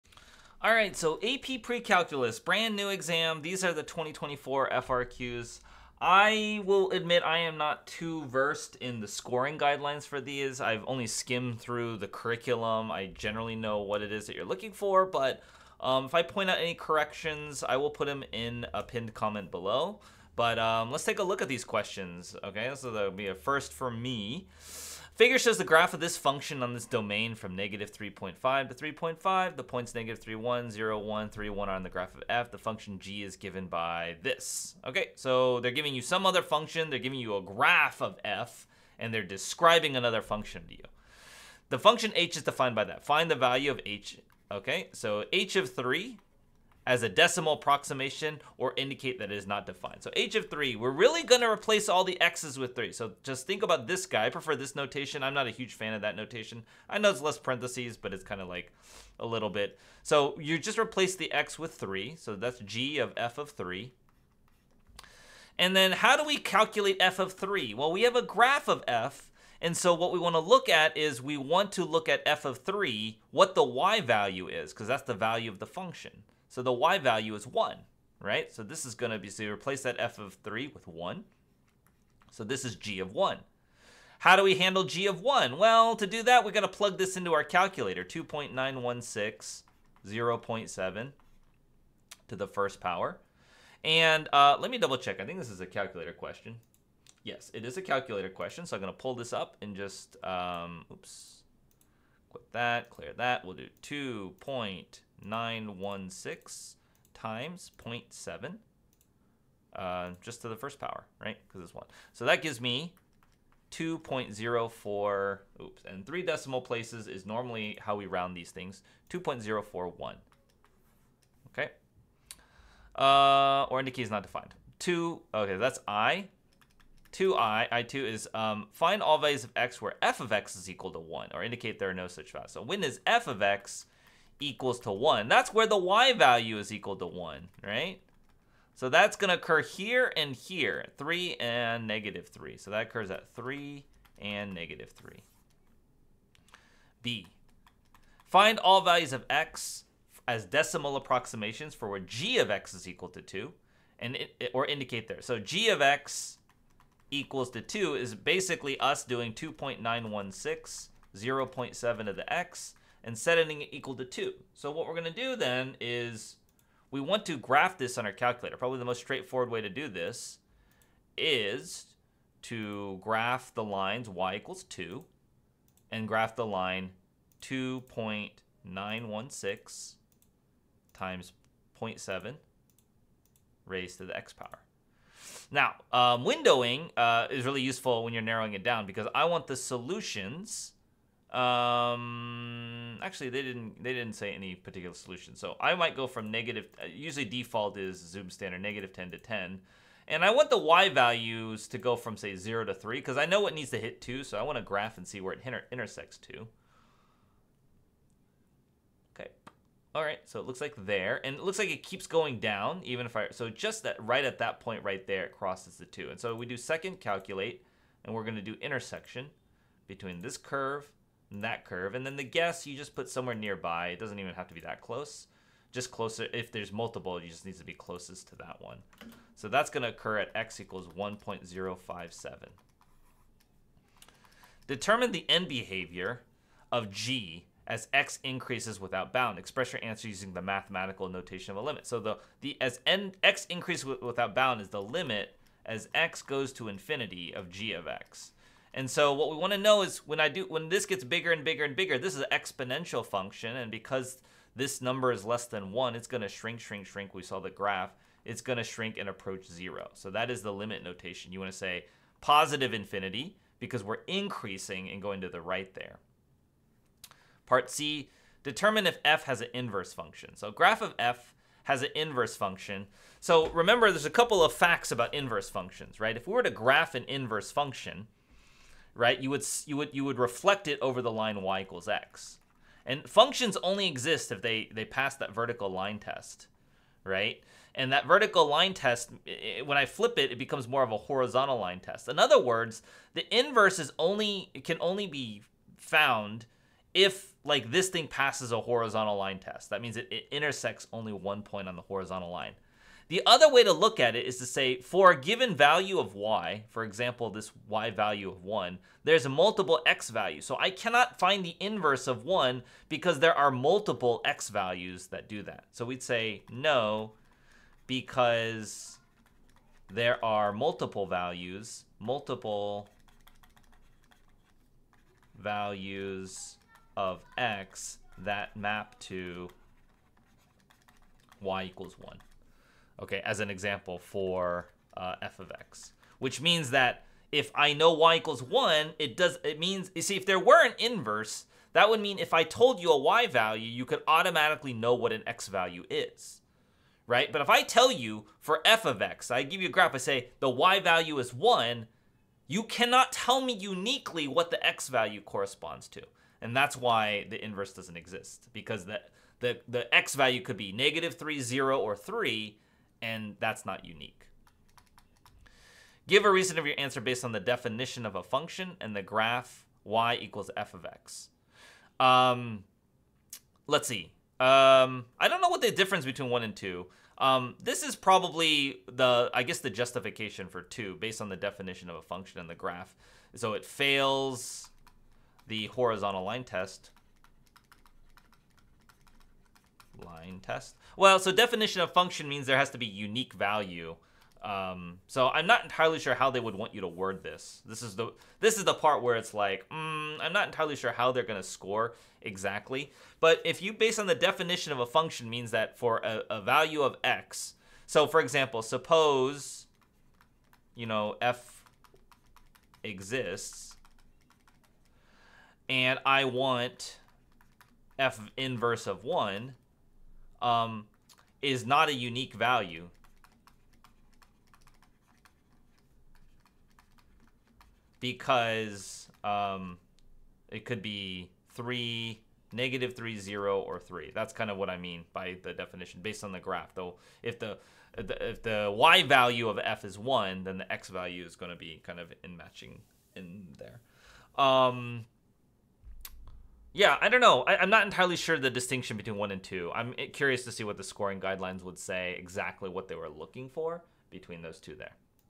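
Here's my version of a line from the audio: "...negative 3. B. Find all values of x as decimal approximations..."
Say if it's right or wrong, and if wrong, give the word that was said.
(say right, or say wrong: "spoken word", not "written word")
right.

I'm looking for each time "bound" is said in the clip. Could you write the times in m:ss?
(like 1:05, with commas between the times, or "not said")
3:59, 4:04.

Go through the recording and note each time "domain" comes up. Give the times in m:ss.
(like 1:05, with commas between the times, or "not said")
0:26.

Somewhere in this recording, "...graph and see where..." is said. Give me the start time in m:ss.
3:24.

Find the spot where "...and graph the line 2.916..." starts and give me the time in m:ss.
2:55.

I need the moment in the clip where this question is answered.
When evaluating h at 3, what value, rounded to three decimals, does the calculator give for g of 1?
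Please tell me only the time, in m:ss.
1:59.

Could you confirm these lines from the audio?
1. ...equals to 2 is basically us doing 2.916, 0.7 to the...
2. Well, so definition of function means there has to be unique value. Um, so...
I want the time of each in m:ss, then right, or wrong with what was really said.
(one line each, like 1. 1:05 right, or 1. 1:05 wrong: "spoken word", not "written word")
1. 2:37 right
2. 6:30 right.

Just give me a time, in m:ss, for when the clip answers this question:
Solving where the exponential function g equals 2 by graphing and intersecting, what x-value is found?
3:50.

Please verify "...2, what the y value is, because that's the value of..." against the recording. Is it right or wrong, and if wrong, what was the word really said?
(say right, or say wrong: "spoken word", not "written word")
wrong: "3", not "2".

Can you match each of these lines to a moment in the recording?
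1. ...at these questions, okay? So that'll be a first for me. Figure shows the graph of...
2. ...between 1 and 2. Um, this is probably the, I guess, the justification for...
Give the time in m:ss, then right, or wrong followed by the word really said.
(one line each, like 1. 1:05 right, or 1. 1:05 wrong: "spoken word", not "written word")
1. 0:21 right
2. 6:16 right.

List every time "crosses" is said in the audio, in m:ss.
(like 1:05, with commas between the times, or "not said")
3:35.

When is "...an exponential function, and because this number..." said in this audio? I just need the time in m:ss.
4:12.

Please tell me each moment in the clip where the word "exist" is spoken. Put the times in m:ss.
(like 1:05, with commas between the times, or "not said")
4:43, 5:57, 6:52.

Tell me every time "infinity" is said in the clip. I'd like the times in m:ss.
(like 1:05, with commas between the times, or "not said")
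4:06, 4:22.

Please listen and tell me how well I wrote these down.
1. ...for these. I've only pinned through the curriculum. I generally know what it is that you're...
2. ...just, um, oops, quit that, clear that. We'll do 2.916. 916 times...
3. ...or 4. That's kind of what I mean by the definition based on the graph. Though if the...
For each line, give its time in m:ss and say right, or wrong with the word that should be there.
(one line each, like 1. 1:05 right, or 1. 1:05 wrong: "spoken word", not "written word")
1. 0:10 wrong: "skimmed", not "pinned"
2. 1:39 right
3. 7:13 wrong: "3", not "4".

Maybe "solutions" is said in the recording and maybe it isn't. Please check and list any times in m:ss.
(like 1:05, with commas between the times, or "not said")
3:09, 3:14.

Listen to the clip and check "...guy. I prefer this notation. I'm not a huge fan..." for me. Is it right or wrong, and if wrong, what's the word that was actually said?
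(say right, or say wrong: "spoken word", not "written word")
right.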